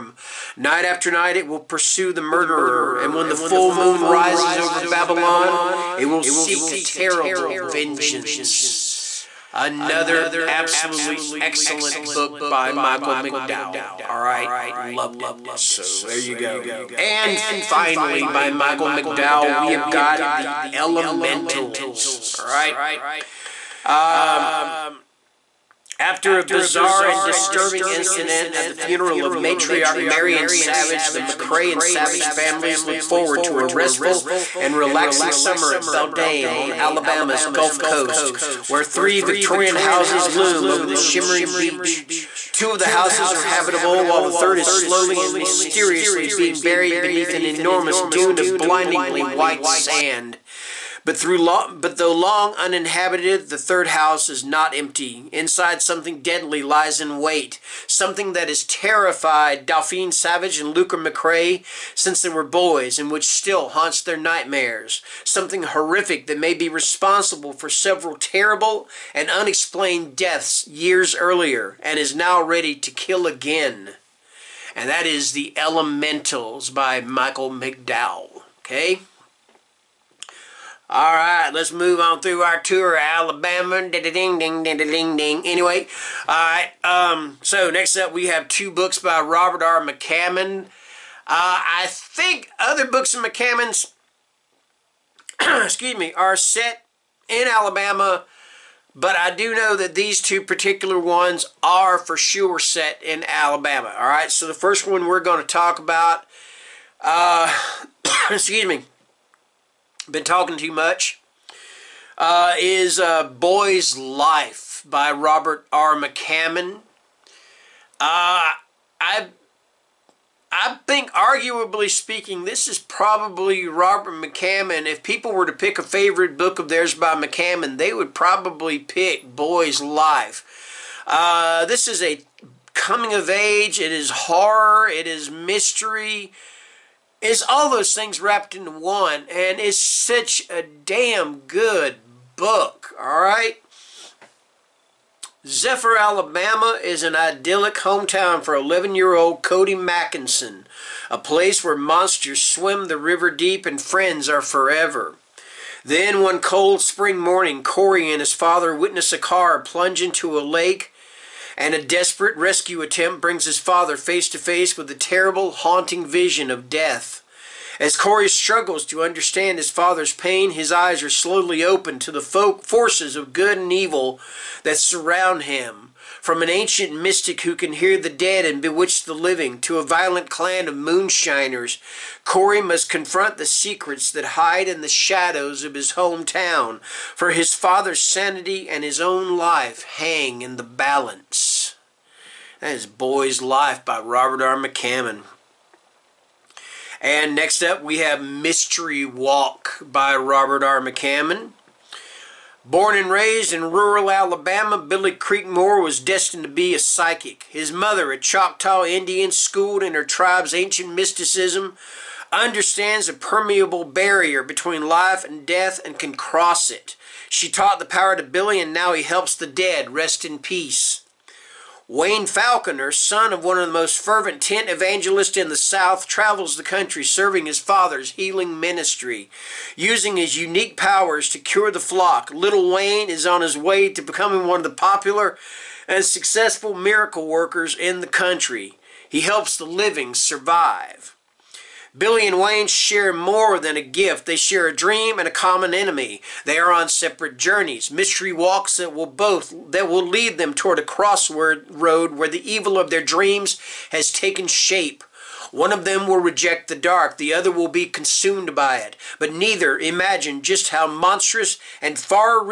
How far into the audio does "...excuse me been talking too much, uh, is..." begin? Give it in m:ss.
1:48.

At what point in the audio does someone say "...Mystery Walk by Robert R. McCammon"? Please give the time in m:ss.
3:18.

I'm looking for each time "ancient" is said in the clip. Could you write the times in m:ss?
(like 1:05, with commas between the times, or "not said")
2:56, 3:30.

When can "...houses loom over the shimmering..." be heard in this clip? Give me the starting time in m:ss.
0:39.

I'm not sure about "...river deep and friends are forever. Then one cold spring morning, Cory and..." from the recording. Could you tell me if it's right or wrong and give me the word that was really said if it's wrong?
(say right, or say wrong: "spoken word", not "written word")
right.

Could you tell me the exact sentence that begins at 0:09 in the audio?
Another absolutely excellent book by Michael McDowell.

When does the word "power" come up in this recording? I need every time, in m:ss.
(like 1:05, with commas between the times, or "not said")
3:37, 3:50.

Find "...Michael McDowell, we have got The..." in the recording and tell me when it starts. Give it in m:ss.
0:18.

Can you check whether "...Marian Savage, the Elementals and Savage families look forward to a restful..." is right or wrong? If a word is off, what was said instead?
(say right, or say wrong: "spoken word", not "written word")
wrong: "McCray", not "Elementals".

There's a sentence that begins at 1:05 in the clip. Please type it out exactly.
Something horrific that may be responsible for several terrible and unexplained deaths years earlier, and is now ready to kill again.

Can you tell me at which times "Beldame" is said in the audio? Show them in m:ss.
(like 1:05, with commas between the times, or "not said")
0:35.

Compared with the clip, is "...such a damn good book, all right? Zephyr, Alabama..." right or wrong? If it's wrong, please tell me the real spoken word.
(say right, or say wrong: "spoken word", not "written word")
right.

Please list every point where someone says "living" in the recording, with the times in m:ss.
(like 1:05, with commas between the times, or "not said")
2:59, 3:59.